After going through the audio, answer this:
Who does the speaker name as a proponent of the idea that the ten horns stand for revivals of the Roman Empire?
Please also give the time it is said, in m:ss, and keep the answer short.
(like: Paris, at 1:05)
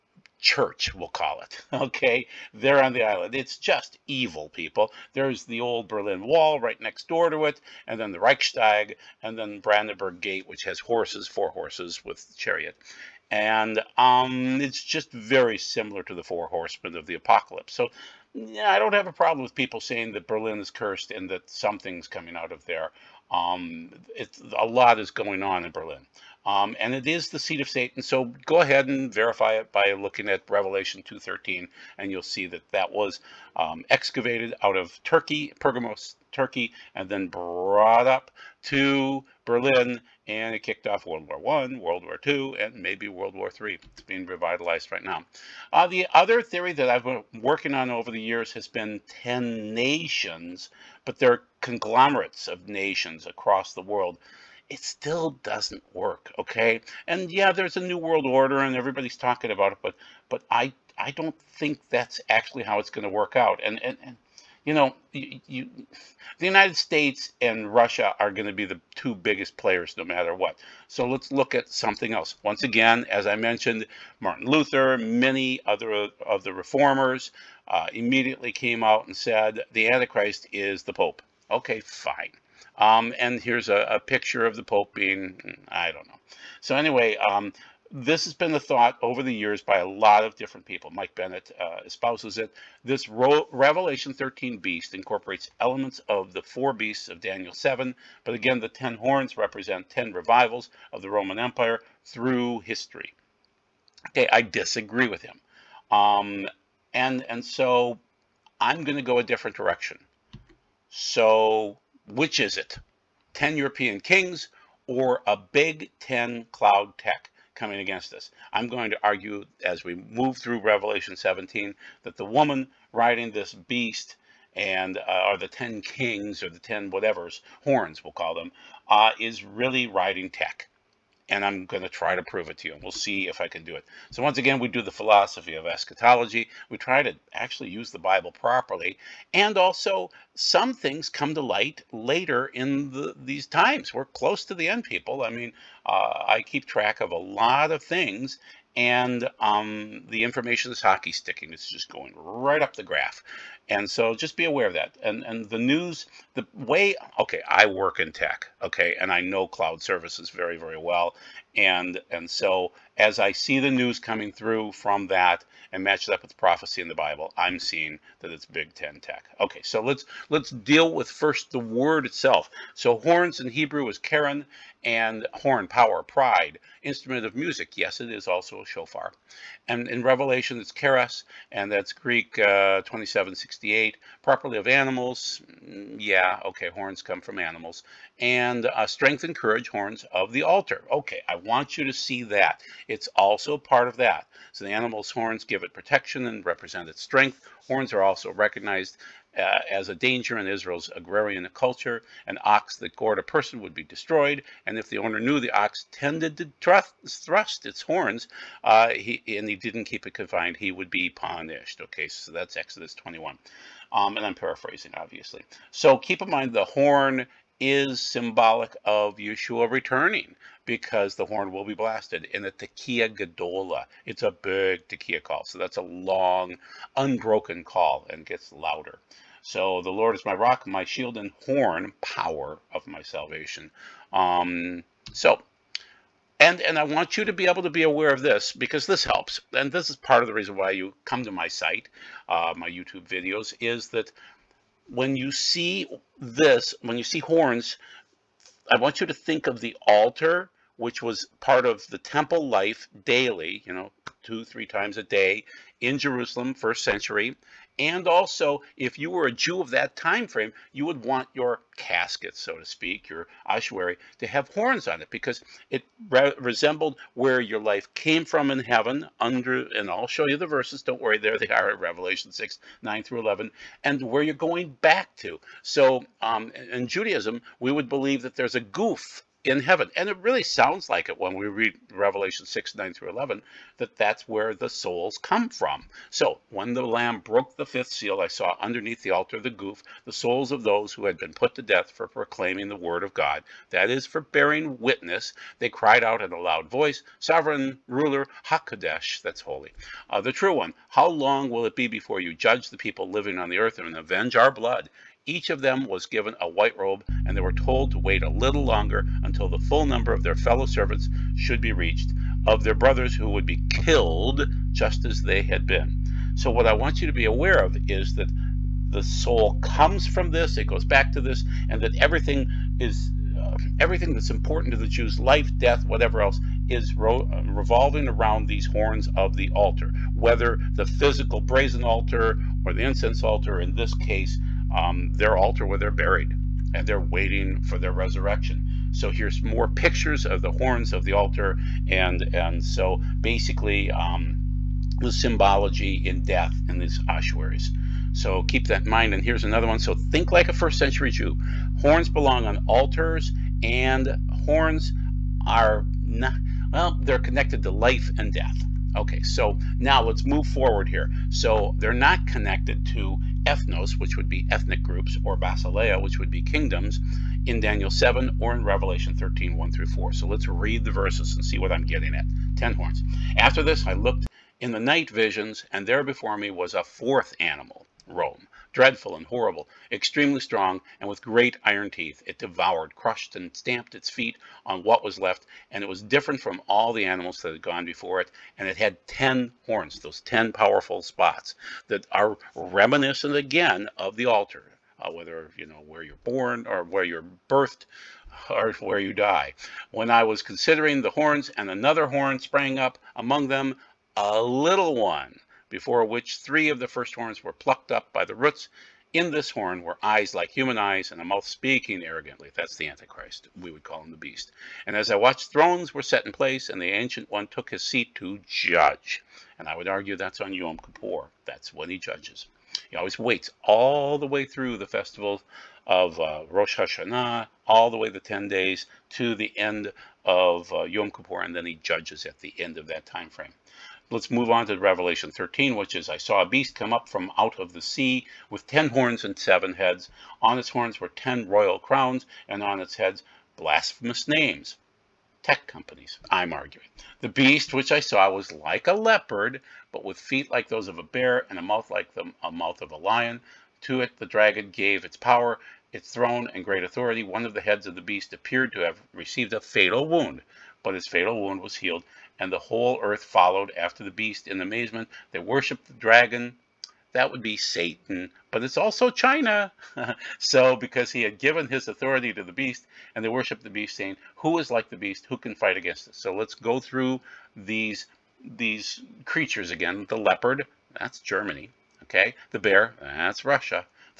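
Mike Bennett, at 1:30.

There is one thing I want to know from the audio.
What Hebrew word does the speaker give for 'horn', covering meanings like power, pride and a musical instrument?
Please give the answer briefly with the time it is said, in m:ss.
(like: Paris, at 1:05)
keren, at 2:53.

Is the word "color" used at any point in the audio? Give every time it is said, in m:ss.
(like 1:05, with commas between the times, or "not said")
not said.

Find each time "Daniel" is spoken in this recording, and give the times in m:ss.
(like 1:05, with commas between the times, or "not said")
1:37, 6:07.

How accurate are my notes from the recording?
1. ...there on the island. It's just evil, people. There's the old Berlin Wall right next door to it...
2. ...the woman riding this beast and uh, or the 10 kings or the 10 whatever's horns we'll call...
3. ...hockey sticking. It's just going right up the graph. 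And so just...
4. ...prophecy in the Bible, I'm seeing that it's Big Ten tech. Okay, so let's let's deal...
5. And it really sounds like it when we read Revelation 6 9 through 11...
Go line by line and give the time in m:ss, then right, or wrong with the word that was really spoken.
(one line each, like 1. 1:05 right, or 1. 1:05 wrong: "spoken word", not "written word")
1. 0:02 right
2. 2:02 right
3. 2:30 right
4. 2:46 right
5. 4:39 right.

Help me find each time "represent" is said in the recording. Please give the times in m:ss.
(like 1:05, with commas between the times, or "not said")
1:39, 3:16.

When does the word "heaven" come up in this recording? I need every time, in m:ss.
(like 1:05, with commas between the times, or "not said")
4:28, 4:39.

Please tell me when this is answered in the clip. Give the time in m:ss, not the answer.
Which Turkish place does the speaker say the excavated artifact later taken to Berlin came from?
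0:35.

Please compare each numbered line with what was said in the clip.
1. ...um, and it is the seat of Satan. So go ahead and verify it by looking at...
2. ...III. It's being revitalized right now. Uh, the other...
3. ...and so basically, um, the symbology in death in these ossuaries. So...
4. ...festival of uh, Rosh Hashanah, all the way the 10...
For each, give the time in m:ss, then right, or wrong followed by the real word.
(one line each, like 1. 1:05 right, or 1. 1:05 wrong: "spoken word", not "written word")
1. 0:26 right
2. 0:43 right
3. 5:42 right
4. 7:04 right.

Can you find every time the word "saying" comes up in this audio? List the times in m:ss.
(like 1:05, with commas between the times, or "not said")
0:19, 7:53.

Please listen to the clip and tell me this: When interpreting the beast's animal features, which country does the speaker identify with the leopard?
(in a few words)
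Germany.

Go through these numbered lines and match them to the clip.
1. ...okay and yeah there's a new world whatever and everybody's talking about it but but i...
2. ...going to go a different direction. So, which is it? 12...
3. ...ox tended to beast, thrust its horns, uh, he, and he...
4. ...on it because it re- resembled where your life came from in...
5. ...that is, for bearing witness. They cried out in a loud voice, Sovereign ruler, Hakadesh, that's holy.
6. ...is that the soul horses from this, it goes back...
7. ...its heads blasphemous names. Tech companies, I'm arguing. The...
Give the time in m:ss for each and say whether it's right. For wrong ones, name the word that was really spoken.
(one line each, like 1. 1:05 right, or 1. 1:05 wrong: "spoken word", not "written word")
1. 0:56 wrong: "order", not "whatever"
2. 1:48 wrong: "10", not "12"
3. 3:25 wrong: "thrust", not "beast"
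4. 4:24 right
5. 4:53 right
6. 5:17 wrong: "comes", not "horses"
7. 7:22 right.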